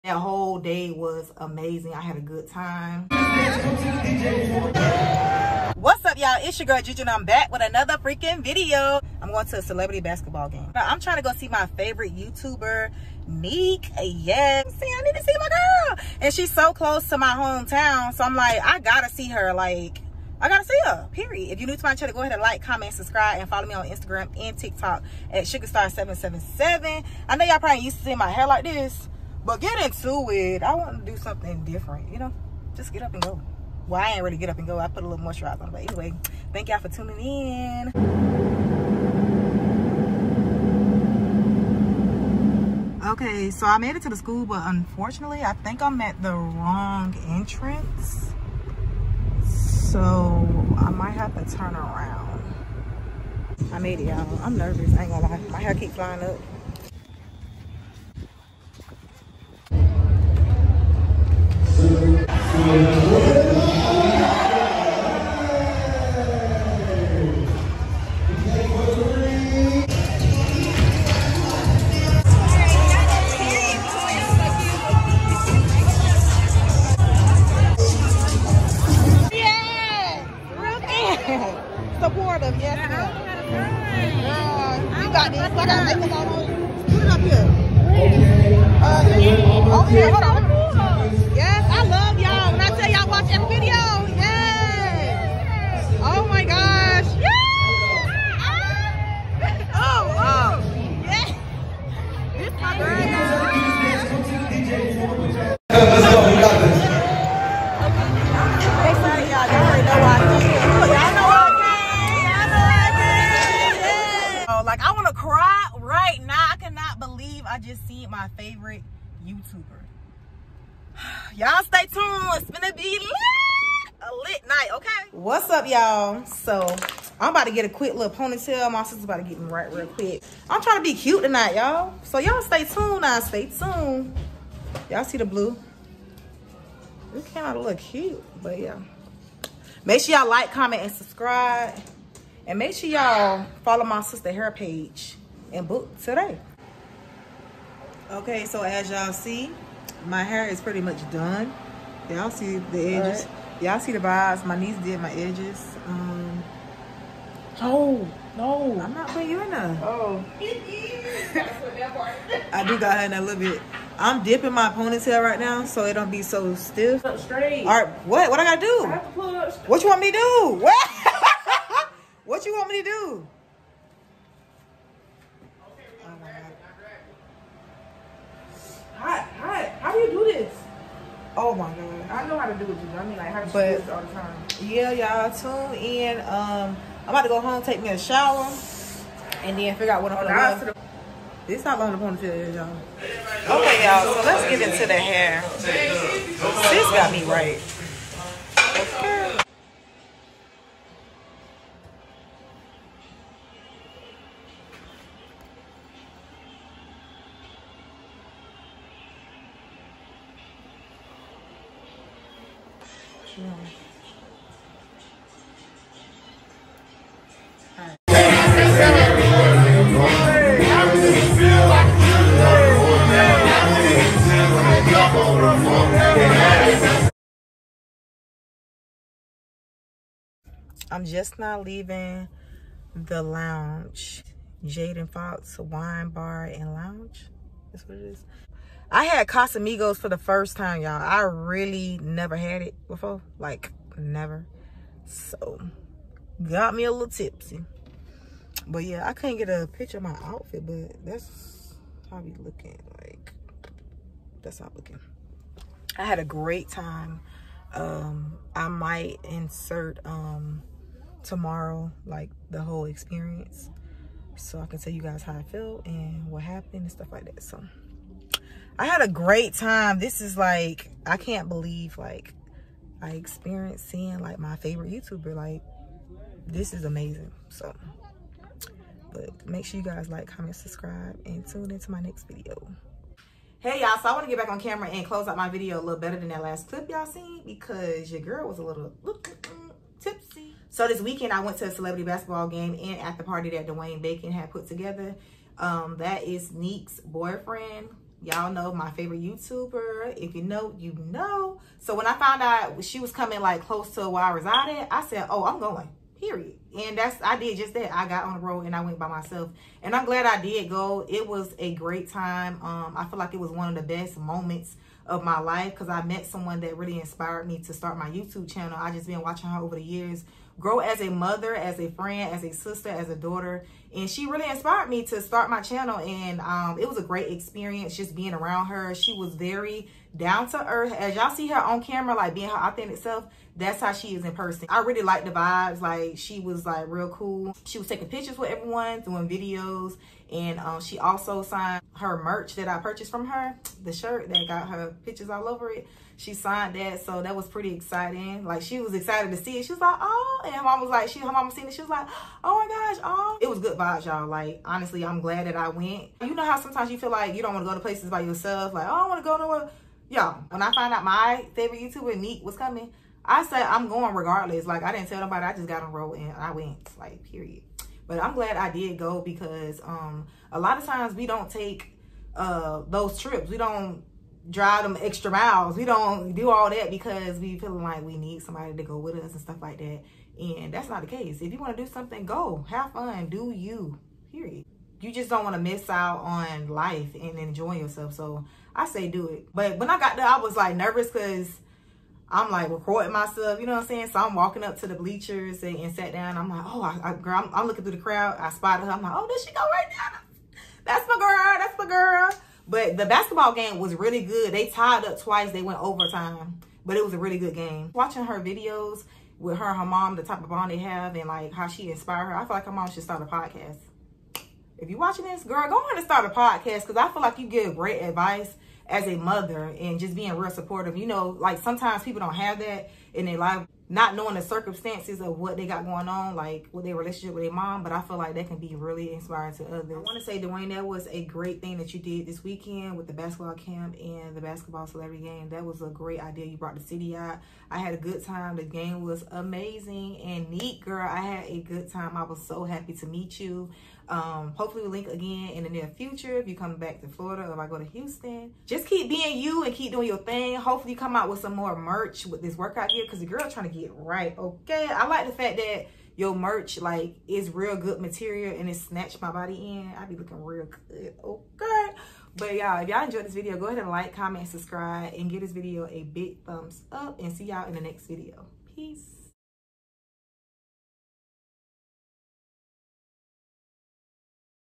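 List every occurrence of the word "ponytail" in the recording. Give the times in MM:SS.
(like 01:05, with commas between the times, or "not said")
02:08, 02:44.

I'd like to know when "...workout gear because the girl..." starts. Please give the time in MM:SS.
07:32.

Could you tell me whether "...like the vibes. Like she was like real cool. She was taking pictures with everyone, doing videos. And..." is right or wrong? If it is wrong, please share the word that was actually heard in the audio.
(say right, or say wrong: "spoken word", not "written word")
right.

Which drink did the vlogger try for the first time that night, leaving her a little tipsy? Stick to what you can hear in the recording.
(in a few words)
Casamigos.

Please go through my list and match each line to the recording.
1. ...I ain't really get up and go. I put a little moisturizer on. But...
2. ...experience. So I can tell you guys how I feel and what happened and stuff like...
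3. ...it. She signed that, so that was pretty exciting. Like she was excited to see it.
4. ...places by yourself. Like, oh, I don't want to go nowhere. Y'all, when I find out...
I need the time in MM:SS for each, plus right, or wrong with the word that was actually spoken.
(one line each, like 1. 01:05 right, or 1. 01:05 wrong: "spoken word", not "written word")
1. 00:34 right
2. 04:22 right
3. 05:45 right
4. 05:57 right.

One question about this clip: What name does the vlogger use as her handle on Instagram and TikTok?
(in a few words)
SugarStar777.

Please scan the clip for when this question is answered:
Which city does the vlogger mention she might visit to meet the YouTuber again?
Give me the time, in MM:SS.
07:27.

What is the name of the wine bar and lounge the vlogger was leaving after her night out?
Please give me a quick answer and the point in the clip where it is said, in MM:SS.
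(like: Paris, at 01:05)
Jaden Fox Wine Bar and Lounge, at 03:54.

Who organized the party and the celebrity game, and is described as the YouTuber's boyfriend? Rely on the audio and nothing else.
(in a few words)
Dwayne Bacon.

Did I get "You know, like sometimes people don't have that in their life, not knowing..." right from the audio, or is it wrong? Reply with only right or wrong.
right.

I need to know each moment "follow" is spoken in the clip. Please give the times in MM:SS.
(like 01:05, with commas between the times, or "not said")
00:23, 02:23.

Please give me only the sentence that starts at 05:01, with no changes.
So when I found out she was coming like close to where I resided, I said, oh, I'm going, period.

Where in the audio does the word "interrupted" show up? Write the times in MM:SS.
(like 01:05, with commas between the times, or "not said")
not said.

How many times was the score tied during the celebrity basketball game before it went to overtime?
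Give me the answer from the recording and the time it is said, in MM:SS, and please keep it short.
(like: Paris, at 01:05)
Twice, at 06:45.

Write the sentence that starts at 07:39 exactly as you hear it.
I be looking real good, okay?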